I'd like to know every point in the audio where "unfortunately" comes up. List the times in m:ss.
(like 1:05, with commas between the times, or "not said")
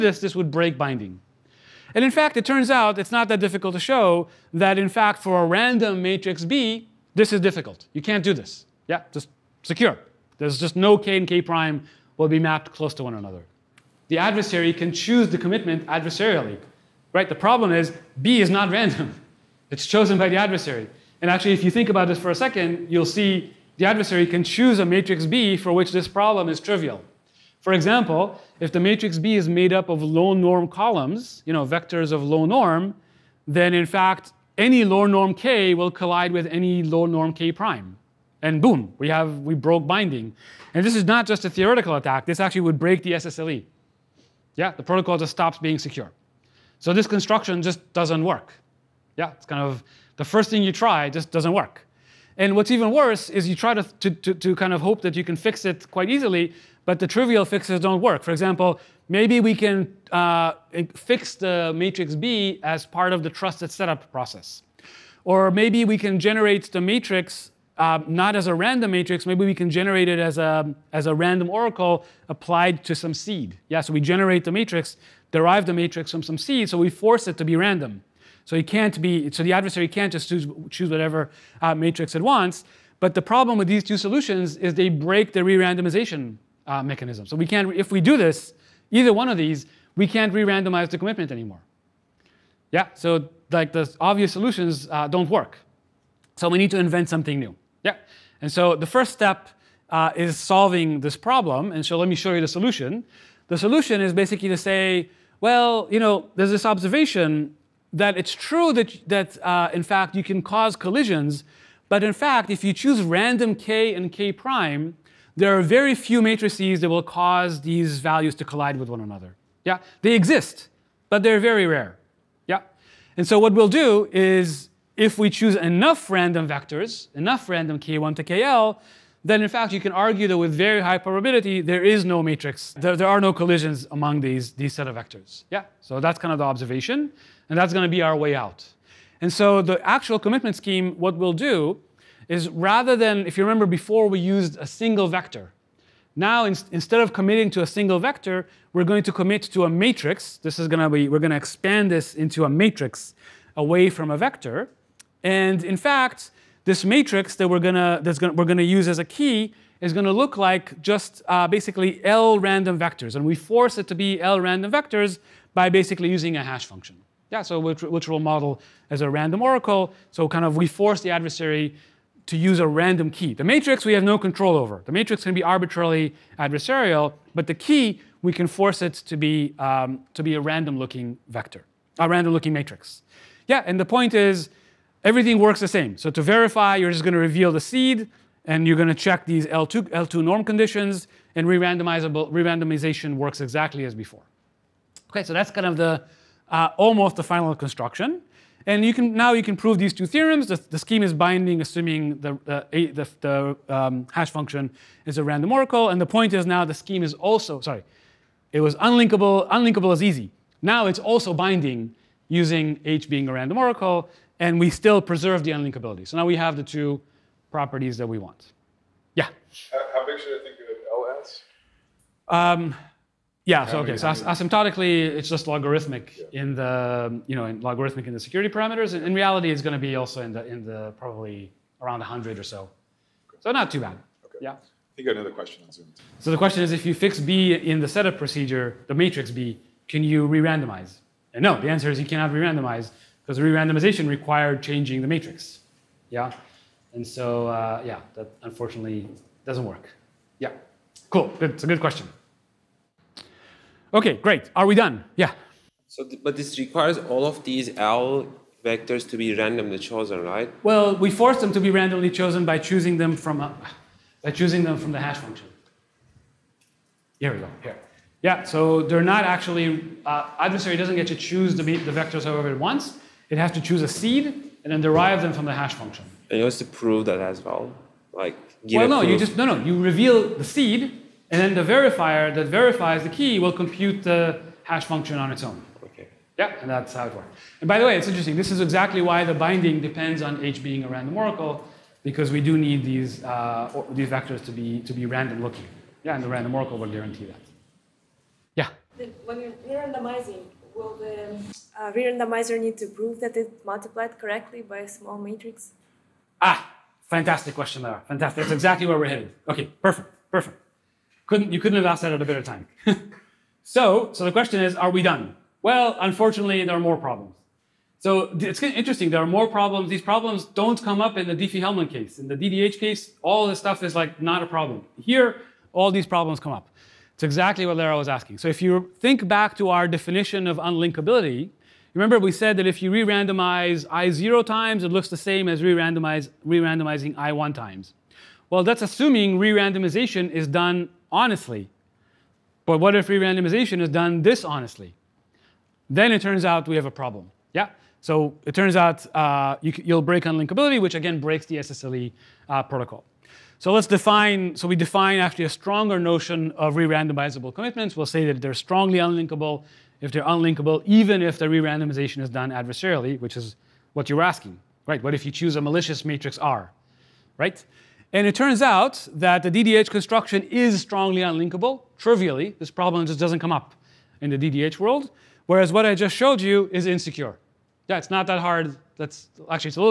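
4:08, 5:15.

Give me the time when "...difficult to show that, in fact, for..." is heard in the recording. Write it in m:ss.
0:03.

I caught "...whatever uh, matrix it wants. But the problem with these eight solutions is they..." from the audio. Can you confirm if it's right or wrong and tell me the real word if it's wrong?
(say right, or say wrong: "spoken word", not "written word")
wrong: "two", not "eight".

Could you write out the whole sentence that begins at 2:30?
This is going to be, we're going to expand this into a matrix away from a vector.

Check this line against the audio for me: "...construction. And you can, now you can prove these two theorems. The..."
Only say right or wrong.
right.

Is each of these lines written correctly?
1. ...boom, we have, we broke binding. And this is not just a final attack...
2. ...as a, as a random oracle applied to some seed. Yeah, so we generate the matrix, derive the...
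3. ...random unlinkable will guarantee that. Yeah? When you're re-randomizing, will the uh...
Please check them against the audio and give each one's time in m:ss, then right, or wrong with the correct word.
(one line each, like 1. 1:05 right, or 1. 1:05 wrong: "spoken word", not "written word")
1. 0:38 wrong: "theoretical", not "final"
2. 1:10 right
3. 4:56 wrong: "oracle", not "unlinkable".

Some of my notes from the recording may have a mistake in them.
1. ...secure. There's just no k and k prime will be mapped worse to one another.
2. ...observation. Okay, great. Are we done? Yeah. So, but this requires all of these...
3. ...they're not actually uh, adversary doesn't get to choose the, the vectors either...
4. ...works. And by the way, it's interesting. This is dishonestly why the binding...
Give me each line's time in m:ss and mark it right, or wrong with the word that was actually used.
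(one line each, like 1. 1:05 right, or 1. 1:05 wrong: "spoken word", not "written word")
1. 0:09 wrong: "close", not "worse"
2. 4:11 wrong: "question", not "observation"
3. 4:28 wrong: "however", not "either"
4. 4:47 wrong: "exactly", not "dishonestly".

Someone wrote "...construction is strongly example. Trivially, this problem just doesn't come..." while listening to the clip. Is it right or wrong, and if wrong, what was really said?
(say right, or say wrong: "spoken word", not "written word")
wrong: "unlinkable", not "example".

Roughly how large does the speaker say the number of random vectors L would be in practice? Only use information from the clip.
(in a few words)
100.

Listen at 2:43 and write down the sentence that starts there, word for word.
And we force it to be L random vectors by basically using a hash function.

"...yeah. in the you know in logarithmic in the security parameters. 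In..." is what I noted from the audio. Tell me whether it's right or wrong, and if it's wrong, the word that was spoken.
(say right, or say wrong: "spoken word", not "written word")
right.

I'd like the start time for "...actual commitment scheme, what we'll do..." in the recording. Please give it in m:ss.
2:19.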